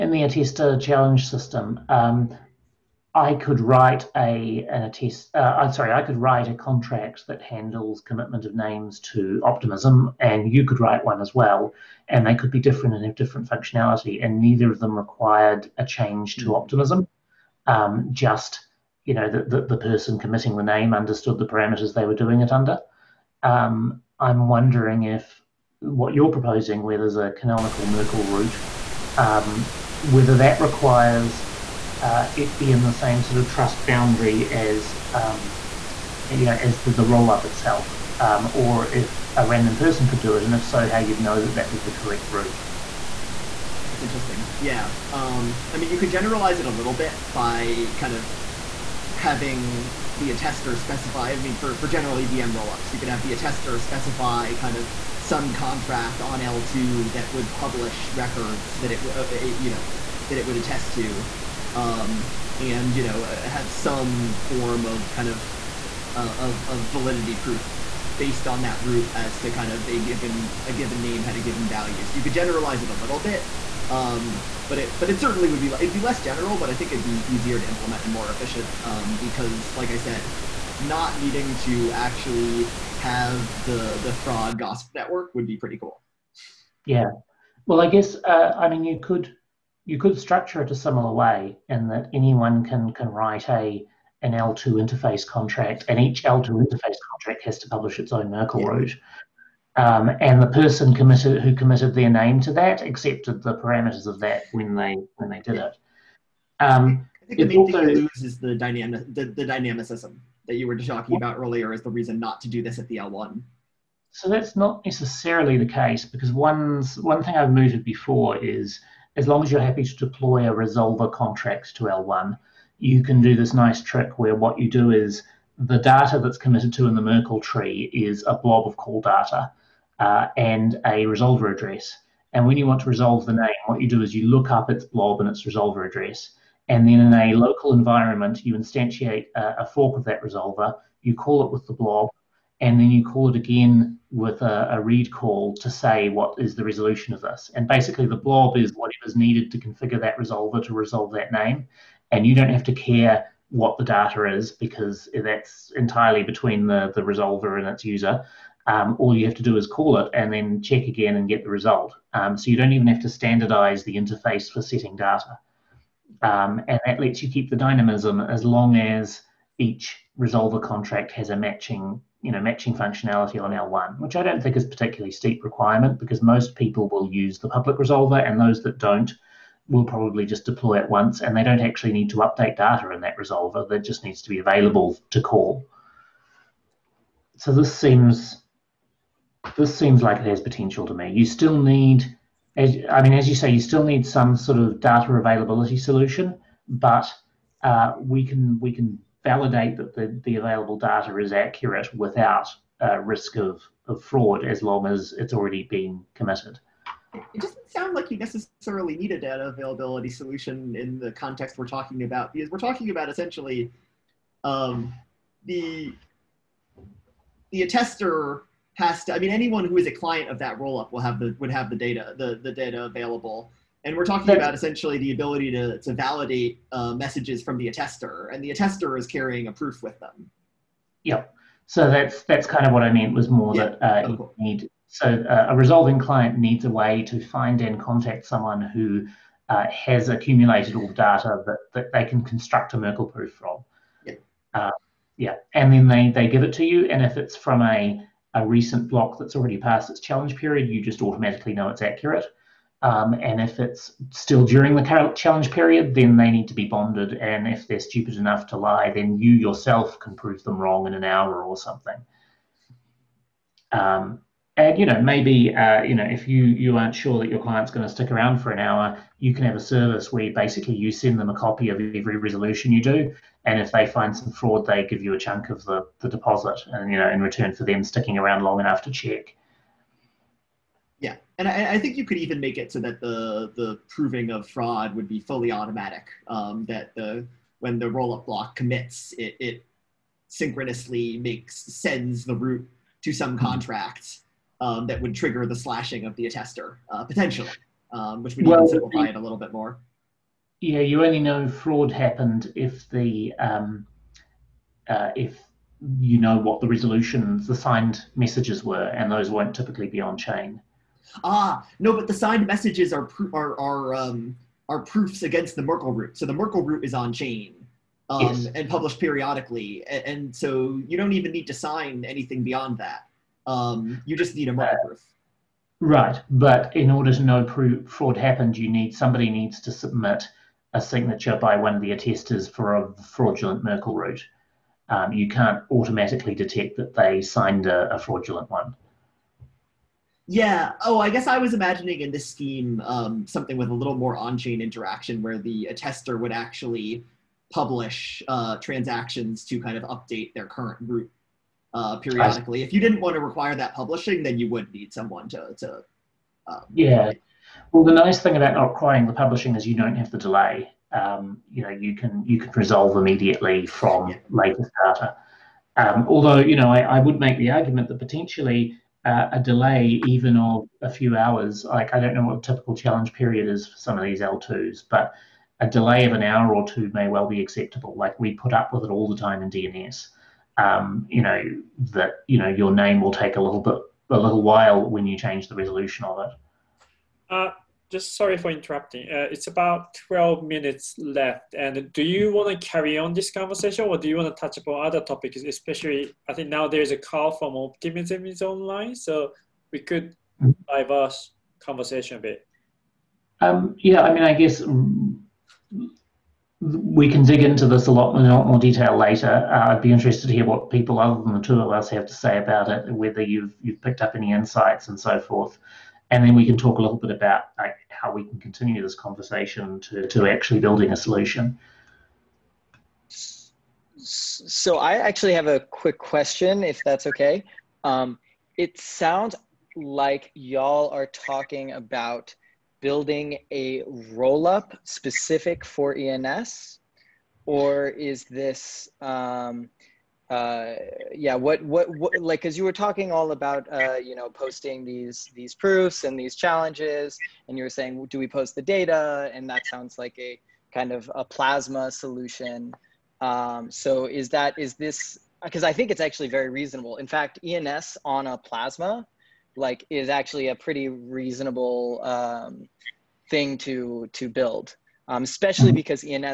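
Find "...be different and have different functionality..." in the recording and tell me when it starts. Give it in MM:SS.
00:12.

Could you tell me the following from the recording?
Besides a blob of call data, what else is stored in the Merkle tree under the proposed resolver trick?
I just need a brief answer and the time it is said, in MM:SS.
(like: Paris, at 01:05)
a resolver address, at 02:10.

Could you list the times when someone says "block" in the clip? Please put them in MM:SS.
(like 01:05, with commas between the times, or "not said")
04:08, 04:48.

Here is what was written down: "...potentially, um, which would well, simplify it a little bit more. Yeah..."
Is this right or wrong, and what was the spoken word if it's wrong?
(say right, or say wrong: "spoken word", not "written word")
right.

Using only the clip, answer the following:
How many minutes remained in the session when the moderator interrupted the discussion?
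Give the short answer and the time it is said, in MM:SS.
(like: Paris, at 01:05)
12, at 06:30.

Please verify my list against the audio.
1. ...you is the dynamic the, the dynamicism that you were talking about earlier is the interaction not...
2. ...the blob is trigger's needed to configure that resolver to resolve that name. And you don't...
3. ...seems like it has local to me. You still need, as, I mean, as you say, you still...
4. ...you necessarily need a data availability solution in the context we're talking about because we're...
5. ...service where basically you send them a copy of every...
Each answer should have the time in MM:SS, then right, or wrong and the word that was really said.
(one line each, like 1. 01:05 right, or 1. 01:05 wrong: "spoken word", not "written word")
1. 01:47 wrong: "reason", not "interaction"
2. 02:28 wrong: "whatever", not "trigger"
3. 03:09 wrong: "potential", not "local"
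4. 03:28 right
5. 04:29 right.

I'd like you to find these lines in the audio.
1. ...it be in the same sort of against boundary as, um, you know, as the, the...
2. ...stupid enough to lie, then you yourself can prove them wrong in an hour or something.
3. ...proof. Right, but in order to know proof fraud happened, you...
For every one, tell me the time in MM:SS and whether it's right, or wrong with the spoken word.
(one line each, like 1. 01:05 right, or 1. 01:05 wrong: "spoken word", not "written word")
1. 00:32 wrong: "trust", not "against"
2. 04:17 right
3. 05:24 right.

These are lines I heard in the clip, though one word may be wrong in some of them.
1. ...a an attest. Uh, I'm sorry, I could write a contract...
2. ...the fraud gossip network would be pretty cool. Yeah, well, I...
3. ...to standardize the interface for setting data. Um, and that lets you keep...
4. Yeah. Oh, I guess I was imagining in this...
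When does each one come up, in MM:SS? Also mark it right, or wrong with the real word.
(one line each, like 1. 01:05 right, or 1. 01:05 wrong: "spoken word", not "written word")
1. 00:04 right
2. 01:24 right
3. 02:43 right
4. 05:40 right.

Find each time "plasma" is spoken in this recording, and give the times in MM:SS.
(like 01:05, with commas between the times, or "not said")
07:31, 07:38.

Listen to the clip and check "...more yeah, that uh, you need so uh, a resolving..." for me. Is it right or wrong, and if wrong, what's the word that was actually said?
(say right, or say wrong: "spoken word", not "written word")
right.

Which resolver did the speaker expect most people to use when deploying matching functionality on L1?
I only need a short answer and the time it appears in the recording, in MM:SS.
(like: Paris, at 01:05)
the public resolver, at 02:57.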